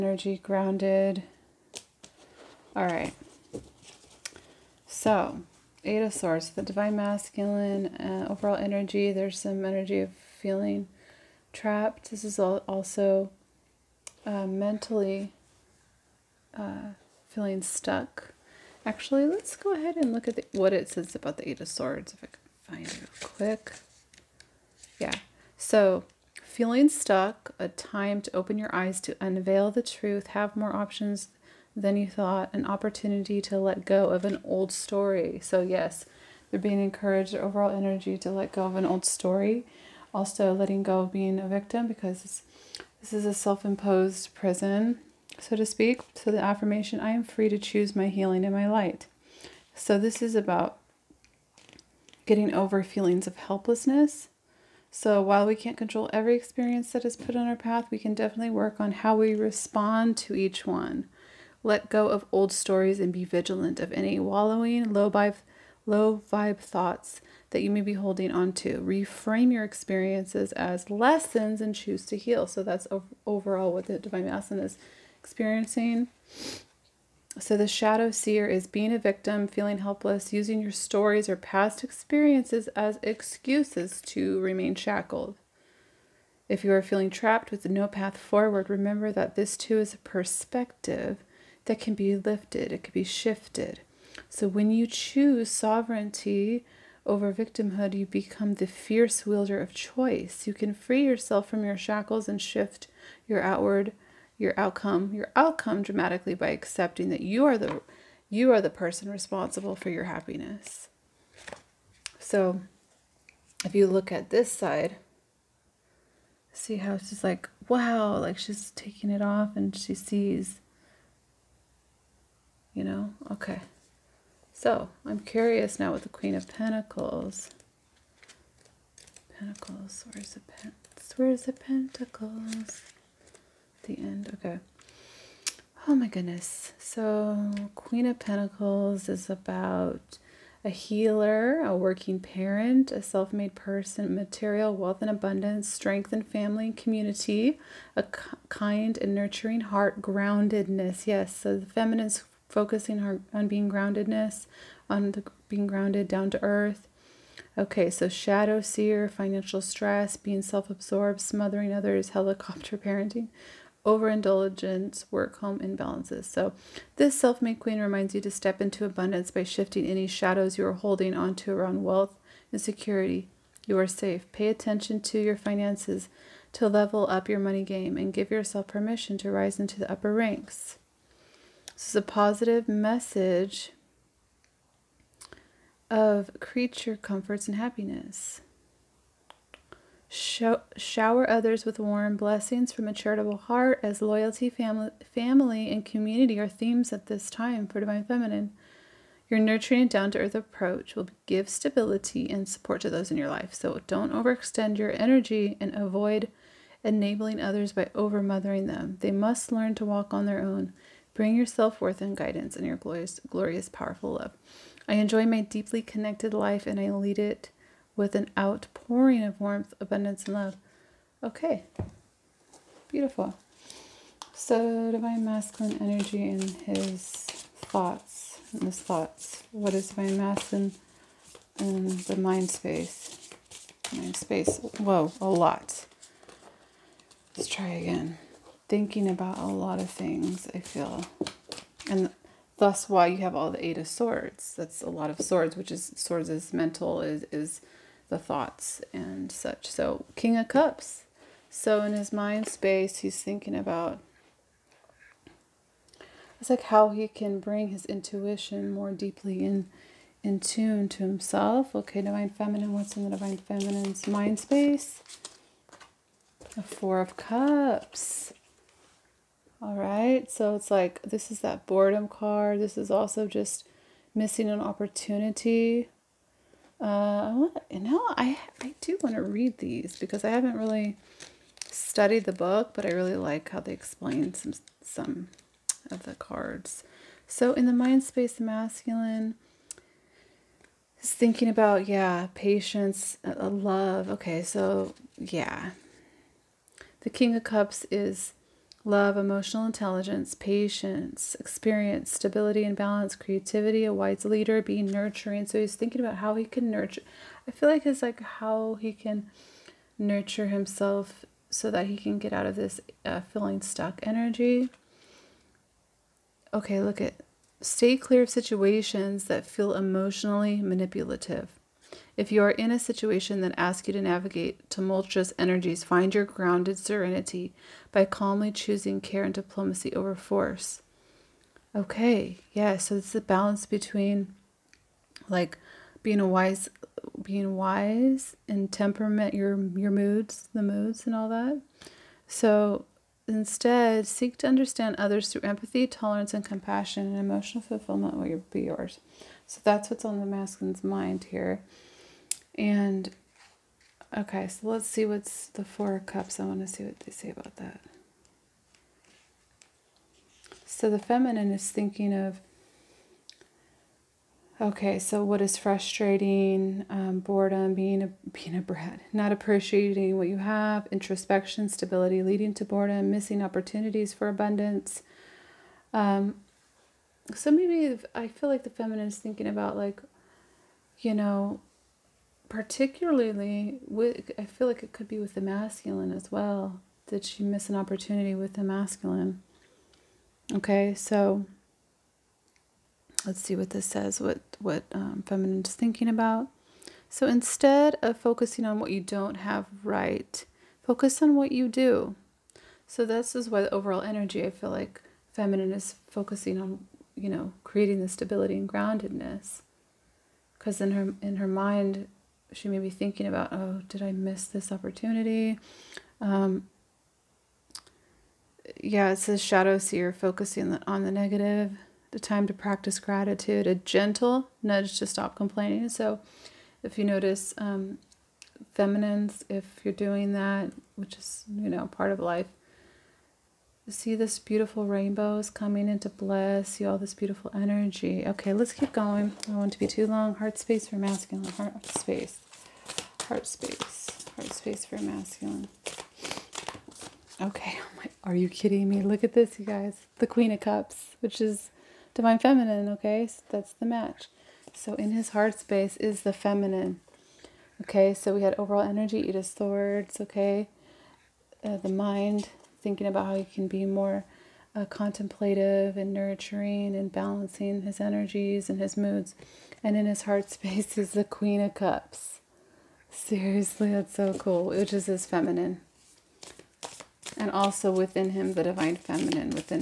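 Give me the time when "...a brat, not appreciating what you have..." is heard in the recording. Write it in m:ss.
6:08.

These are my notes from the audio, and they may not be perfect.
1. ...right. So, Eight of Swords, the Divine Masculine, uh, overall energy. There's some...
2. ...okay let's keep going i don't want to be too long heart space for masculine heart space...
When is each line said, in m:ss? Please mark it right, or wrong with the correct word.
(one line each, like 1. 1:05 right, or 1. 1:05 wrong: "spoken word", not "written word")
1. 0:02 right
2. 7:18 right.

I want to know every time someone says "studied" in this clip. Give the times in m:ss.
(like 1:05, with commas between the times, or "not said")
4:41.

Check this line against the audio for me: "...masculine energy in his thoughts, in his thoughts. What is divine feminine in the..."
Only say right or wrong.
wrong.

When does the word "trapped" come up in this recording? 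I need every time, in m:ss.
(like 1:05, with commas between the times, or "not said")
0:11, 1:27.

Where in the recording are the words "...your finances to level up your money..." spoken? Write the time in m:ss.
2:55.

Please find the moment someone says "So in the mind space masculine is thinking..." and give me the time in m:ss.
4:47.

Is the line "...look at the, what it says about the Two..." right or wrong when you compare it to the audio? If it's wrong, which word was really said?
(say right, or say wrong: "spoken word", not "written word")
wrong: "Eight", not "Two".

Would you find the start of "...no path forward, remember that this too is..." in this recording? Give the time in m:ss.
1:27.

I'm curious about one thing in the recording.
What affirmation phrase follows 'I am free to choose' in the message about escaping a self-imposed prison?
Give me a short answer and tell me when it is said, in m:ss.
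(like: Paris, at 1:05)
my healing and my light, at 0:47.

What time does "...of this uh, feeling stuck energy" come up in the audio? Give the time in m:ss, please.
5:12.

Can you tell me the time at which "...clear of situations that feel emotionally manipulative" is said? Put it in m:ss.
5:17.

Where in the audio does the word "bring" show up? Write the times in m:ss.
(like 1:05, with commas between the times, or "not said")
3:31, 4:17.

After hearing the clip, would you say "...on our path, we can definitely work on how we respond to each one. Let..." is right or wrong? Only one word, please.
right.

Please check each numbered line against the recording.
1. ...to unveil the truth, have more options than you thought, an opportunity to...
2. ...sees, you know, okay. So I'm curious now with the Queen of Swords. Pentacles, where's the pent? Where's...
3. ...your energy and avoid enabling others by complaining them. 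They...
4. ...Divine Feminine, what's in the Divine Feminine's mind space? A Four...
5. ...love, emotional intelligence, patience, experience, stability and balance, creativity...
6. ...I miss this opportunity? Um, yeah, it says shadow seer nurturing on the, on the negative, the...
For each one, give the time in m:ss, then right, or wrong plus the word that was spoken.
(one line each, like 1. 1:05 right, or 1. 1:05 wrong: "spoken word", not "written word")
1. 0:29 right
2. 1:59 wrong: "Pentacles", not "Swords"
3. 3:24 wrong: "overmothering", not "complaining"
4. 4:22 right
5. 4:58 right
6. 6:54 wrong: "focusing", not "nurturing".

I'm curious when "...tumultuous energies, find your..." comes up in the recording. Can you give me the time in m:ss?
5:24.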